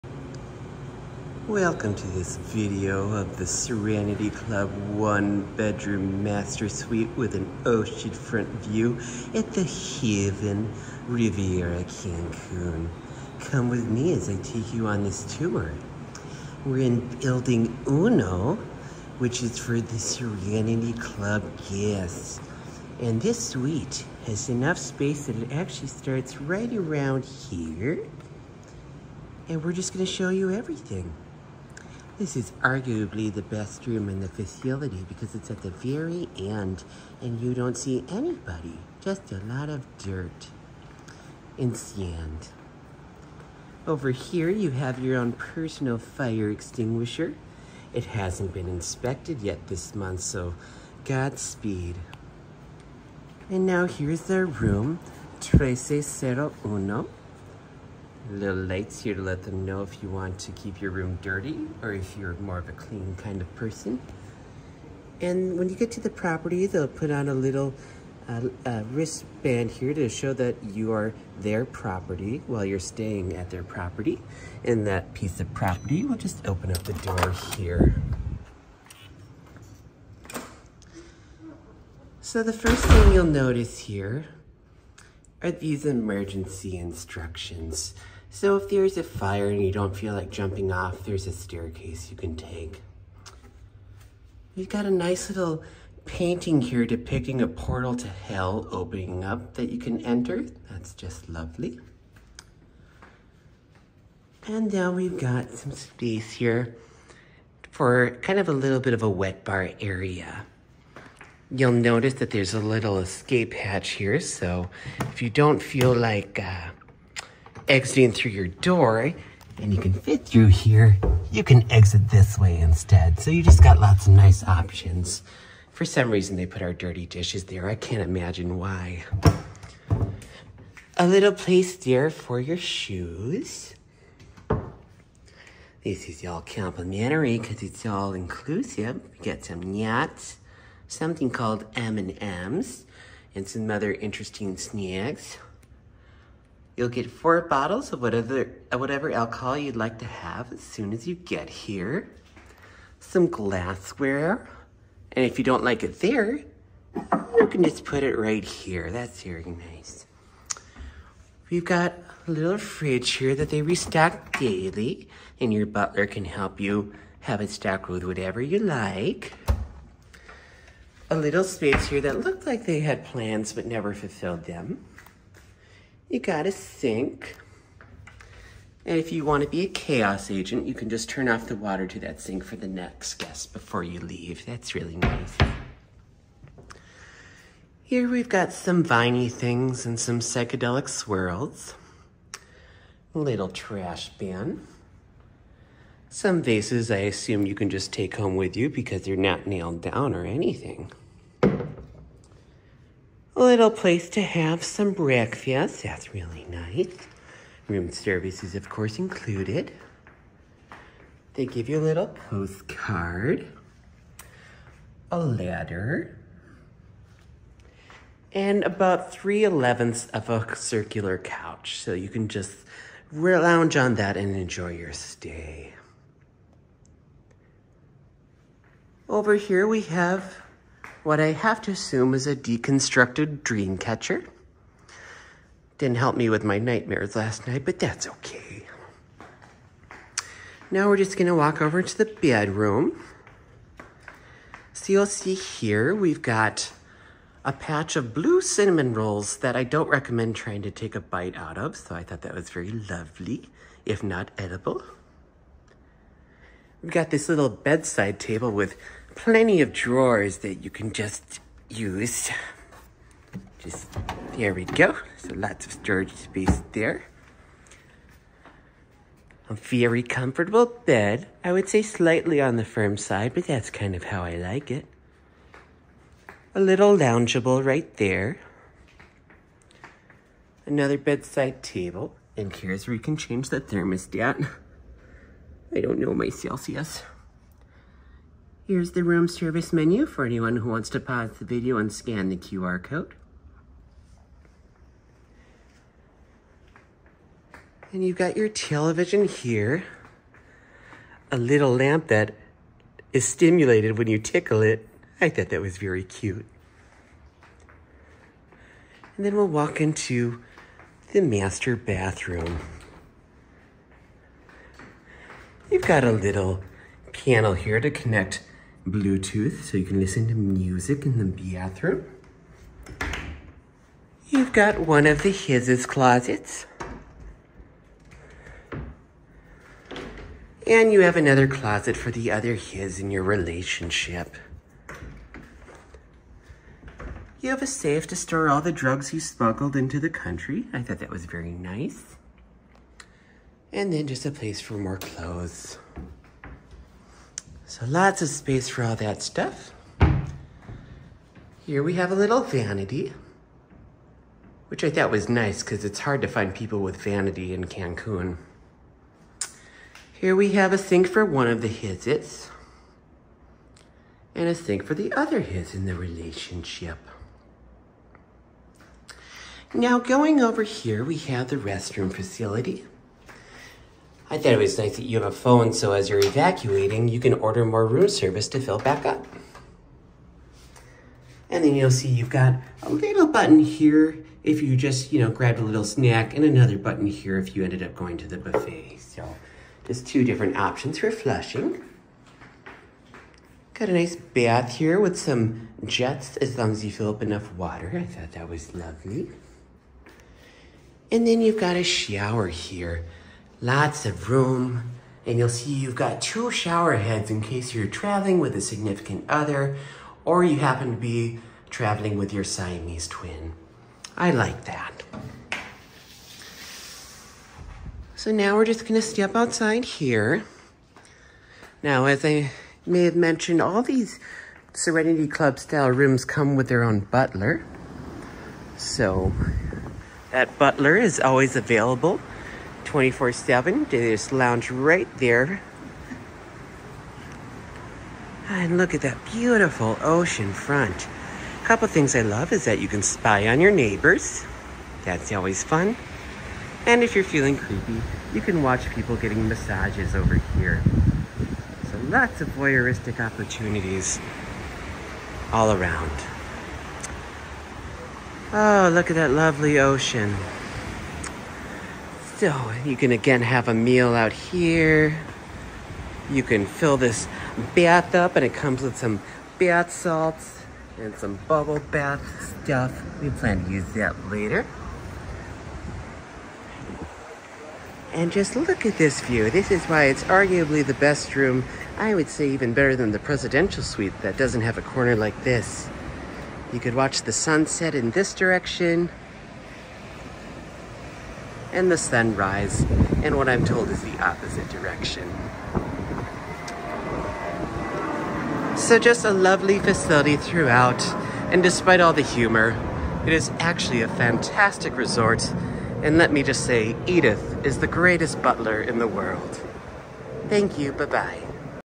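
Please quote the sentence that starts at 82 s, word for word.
So the first thing you'll notice here are these emergency instructions.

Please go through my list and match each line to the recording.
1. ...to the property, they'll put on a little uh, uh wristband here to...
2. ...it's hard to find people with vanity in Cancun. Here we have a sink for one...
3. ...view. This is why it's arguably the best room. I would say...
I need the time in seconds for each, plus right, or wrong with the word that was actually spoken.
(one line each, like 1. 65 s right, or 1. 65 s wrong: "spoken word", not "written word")
1. 65 s right
2. 355 s right
3. 479 s right.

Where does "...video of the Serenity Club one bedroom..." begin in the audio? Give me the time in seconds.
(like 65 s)
2 s.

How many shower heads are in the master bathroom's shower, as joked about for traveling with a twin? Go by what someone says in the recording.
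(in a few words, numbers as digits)
2.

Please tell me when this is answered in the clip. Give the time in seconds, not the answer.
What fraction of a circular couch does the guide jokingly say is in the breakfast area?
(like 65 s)
219 s.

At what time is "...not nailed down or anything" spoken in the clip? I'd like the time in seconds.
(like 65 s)
199 s.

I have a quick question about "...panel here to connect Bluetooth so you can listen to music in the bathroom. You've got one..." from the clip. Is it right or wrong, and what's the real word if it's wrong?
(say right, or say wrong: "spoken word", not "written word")
right.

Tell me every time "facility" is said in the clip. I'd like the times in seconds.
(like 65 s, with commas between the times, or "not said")
34 s, 372 s, 499 s.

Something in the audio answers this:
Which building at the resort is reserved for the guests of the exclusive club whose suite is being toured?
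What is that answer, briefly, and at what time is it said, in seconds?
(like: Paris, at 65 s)
Building Uno, at 17 s.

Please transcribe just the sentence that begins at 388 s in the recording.
So just two different options for flushing.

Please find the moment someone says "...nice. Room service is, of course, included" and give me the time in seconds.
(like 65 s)
206 s.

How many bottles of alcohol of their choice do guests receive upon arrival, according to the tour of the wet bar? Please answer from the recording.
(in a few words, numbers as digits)
4.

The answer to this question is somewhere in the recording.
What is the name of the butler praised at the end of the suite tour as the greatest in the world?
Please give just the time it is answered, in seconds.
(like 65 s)
507 s.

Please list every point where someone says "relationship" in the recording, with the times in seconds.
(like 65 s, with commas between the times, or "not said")
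333 s, 365 s.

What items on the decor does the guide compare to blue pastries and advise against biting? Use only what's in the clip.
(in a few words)
Blue cinnamon rolls.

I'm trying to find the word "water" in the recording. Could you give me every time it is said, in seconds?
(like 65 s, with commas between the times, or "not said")
181 s, 397 s.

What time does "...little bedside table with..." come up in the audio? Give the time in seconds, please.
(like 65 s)
257 s.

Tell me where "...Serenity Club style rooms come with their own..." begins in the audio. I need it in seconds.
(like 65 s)
424 s.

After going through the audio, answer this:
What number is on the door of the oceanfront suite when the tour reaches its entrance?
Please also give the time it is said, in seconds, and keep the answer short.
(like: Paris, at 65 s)
1301, at 55 s.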